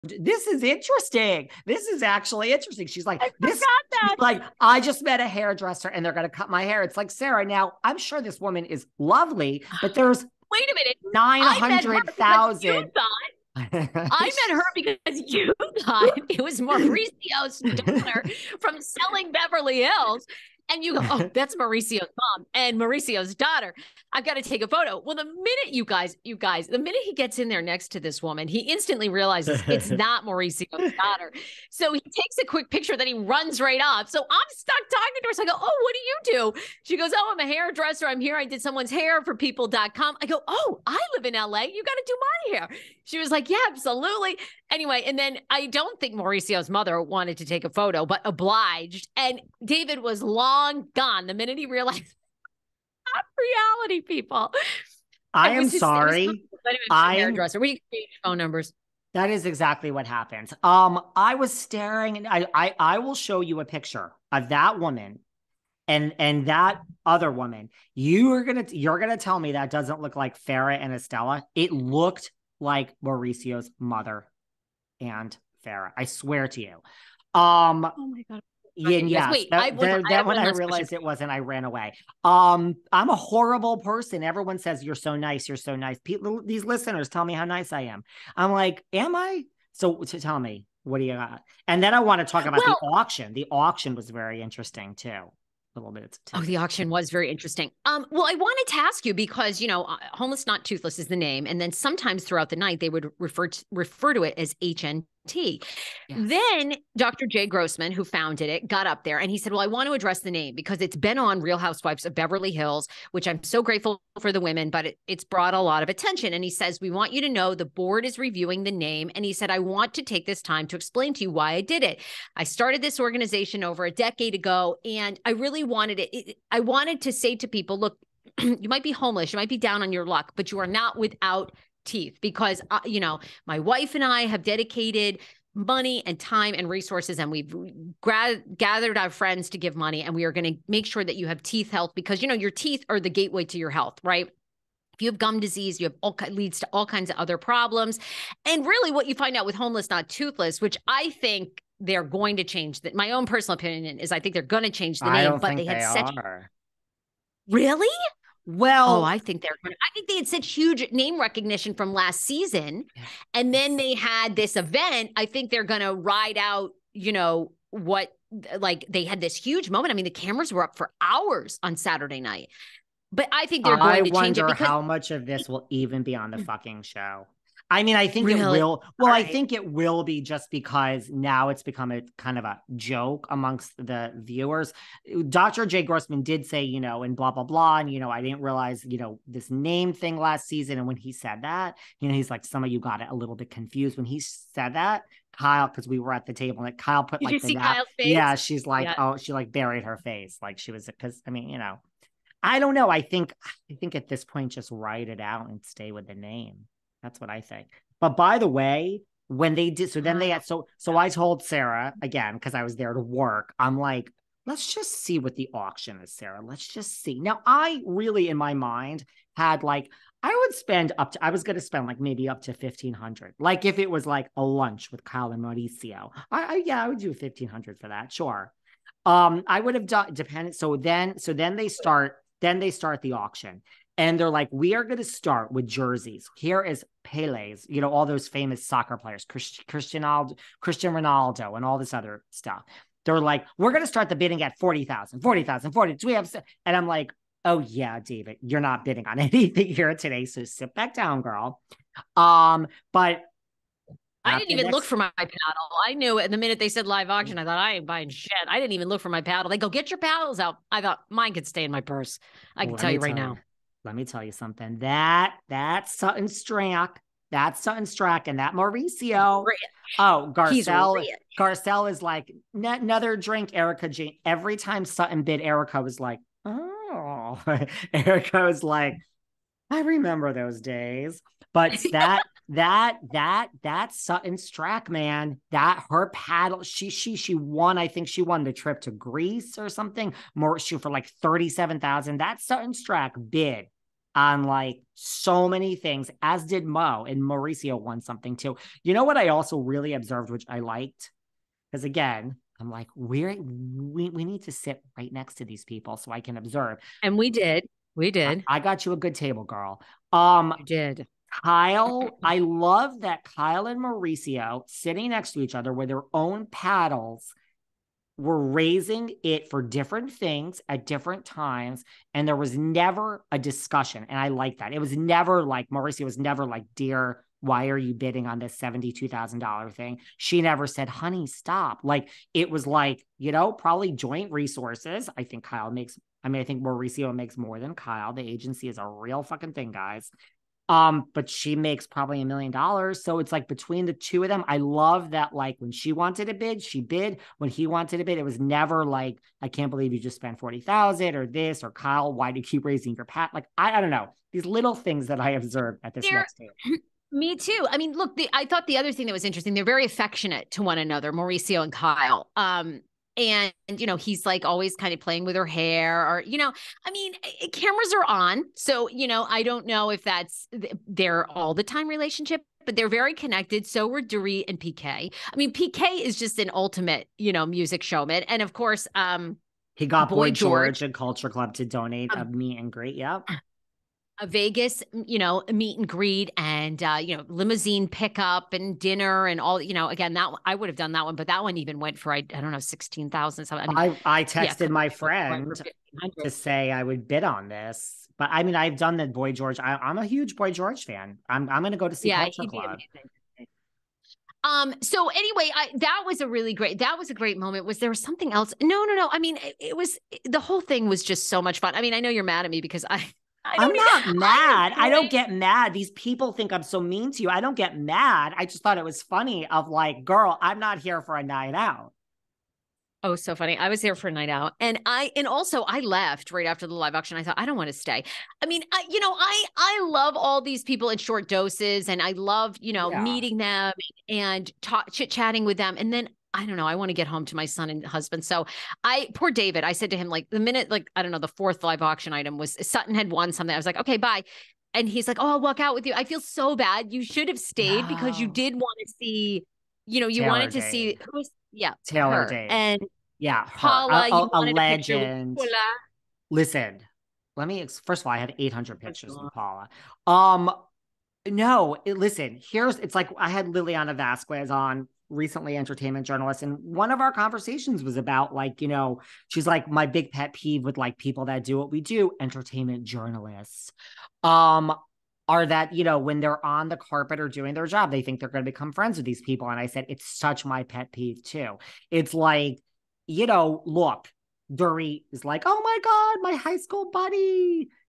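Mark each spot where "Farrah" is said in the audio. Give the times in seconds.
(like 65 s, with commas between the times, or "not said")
70 s, 75 s.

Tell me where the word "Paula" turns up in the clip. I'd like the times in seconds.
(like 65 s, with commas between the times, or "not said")
453 s, 459 s.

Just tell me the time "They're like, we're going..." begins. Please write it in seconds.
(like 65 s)
243 s.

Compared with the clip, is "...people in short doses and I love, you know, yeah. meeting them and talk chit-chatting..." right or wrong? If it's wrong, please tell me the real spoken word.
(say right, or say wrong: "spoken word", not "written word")
right.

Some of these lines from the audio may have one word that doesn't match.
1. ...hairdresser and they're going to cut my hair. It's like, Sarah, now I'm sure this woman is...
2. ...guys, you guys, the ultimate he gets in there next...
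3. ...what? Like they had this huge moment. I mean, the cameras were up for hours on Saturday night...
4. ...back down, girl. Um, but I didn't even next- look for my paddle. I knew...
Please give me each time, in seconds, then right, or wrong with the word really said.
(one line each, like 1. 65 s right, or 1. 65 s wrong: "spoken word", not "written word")
1. 5 s right
2. 25 s wrong: "minute", not "ultimate"
3. 167 s right
4. 250 s right.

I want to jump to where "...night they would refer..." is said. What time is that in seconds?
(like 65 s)
102 s.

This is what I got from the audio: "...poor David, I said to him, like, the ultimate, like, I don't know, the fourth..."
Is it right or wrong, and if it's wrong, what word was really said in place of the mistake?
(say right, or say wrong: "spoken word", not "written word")
wrong: "minute", not "ultimate".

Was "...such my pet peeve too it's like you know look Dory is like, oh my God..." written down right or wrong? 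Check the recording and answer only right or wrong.
right.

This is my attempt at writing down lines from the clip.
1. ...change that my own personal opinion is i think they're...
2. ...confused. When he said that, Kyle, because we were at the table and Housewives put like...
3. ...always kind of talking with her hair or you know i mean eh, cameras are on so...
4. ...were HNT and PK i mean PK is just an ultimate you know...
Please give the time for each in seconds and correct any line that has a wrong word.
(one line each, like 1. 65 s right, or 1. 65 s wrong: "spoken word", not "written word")
1. 152 s right
2. 193 s wrong: "Kyle", not "Housewives"
3. 364 s wrong: "playing", not "talking"
4. 373 s wrong: "Dorit", not "HNT".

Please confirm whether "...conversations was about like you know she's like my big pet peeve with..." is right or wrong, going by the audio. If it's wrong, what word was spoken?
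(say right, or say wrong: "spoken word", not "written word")
right.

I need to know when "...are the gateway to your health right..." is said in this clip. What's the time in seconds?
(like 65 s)
142 s.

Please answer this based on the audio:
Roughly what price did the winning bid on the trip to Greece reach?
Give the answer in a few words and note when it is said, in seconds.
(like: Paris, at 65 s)
37,000, at 291 s.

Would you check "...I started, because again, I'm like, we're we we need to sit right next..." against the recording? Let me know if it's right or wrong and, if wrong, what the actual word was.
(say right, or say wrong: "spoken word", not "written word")
wrong: "liked", not "started".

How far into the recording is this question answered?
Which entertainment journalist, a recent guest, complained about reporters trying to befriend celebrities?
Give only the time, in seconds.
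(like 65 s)
463 s.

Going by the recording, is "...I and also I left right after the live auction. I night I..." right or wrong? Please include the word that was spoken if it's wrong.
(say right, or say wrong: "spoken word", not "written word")
wrong: "thought", not "night".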